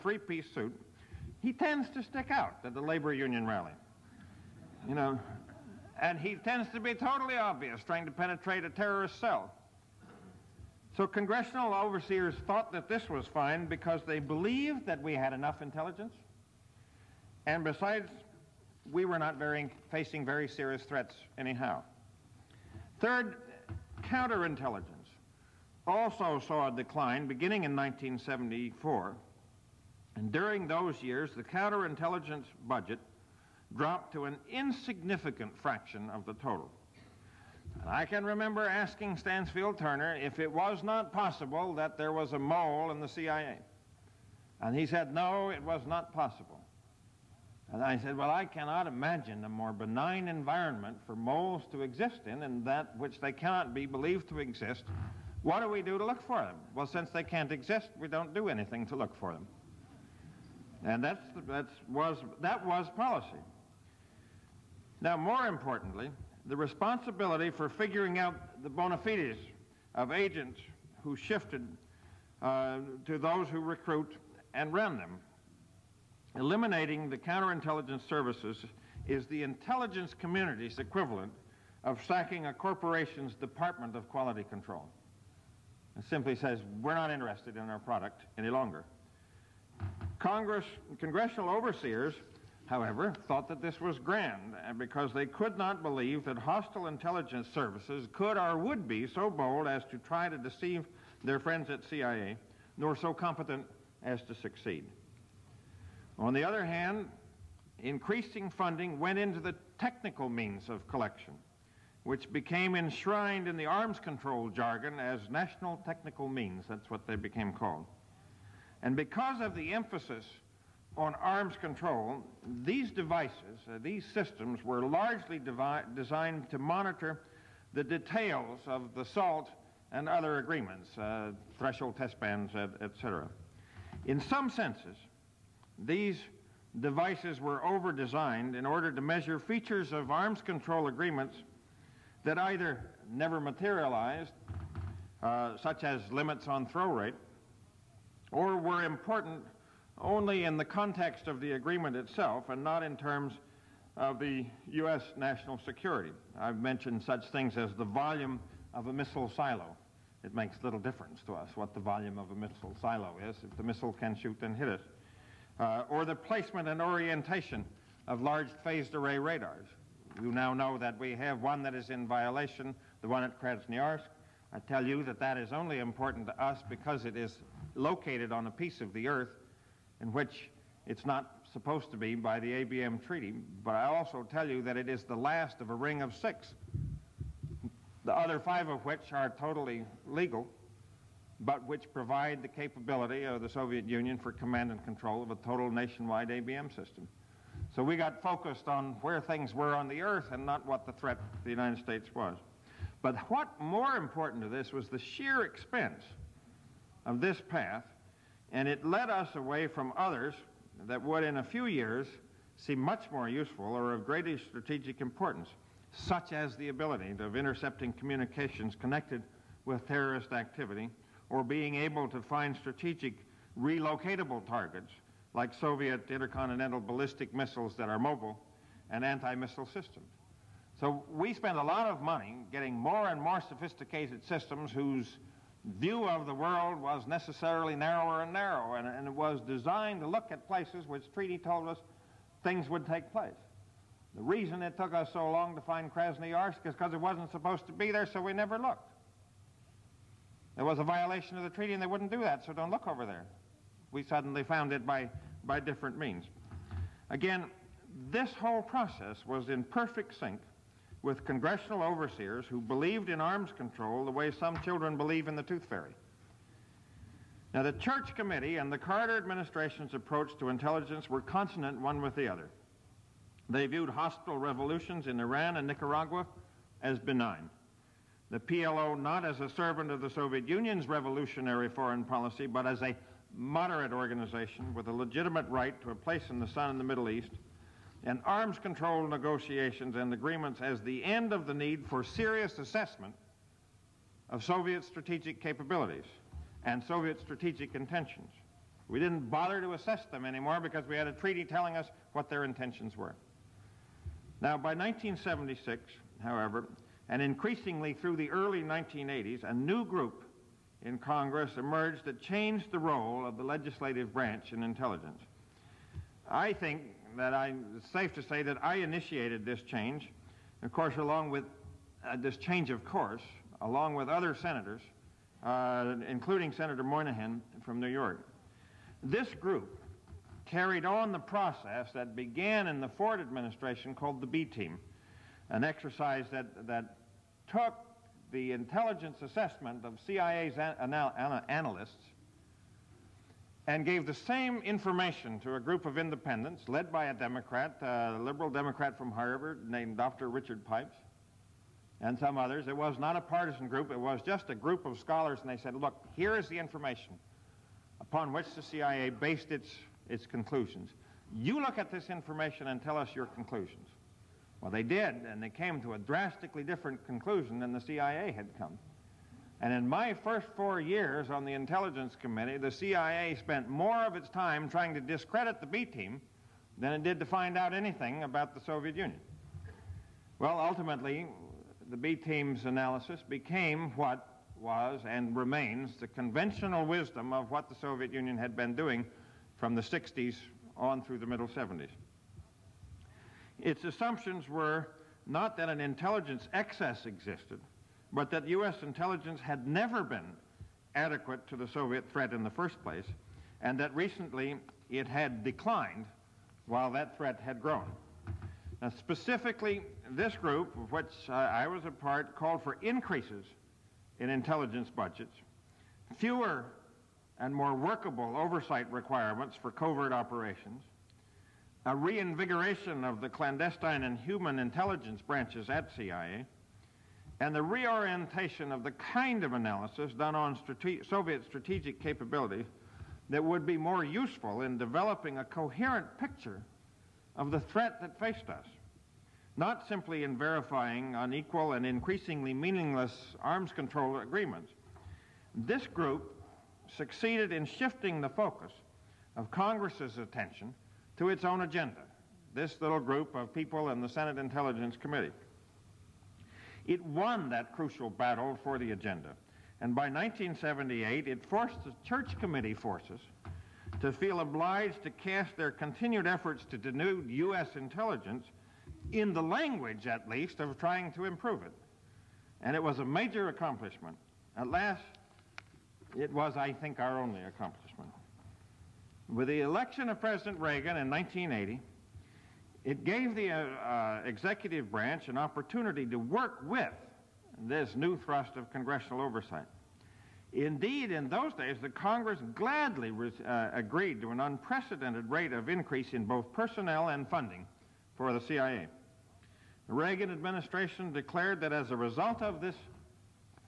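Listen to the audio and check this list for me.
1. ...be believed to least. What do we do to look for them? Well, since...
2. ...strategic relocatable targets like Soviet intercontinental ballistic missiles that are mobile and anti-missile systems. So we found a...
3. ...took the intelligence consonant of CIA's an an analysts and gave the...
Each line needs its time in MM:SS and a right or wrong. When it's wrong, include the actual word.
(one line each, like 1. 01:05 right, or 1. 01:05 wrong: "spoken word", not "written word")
1. 00:53 wrong: "exist", not "least"
2. 03:42 wrong: "spend", not "found"
3. 05:37 wrong: "assessment", not "consonant".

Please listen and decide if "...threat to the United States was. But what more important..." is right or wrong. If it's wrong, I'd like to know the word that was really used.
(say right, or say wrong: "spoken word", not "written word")
right.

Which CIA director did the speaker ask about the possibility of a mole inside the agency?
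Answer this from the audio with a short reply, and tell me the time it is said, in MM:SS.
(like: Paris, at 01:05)
Stansfield Turner, at 00:39.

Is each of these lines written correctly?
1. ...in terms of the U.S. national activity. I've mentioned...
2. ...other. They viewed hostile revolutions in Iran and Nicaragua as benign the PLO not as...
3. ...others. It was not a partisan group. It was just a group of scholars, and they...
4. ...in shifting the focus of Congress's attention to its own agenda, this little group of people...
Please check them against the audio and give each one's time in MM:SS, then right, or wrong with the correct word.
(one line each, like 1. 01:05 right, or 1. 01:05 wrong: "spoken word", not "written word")
1. 02:32 wrong: "security", not "activity"
2. 04:32 right
3. 05:52 right
4. 07:27 right.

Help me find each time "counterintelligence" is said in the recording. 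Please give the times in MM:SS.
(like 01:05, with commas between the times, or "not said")
00:24, 00:31, 01:17.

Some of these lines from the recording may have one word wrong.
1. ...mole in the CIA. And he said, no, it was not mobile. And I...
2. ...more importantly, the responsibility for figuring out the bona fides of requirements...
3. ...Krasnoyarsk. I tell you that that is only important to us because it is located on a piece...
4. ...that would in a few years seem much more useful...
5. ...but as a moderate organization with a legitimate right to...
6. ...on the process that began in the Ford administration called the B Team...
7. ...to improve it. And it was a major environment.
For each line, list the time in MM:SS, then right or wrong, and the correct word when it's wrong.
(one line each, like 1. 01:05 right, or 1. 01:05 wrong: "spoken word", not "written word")
1. 00:42 wrong: "possible", not "mobile"
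2. 01:05 wrong: "agents", not "requirements"
3. 02:53 right
4. 03:30 right
5. 04:42 right
6. 05:30 right
7. 07:51 wrong: "accomplishment", not "environment".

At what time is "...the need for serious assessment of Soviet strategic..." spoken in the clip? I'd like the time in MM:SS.
04:51.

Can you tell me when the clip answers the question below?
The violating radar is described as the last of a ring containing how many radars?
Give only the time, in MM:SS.
03:06.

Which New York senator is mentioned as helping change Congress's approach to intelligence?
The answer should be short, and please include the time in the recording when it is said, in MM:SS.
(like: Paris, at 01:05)
Senator Moynihan, at 05:26.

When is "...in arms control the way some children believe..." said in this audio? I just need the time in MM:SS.
04:23.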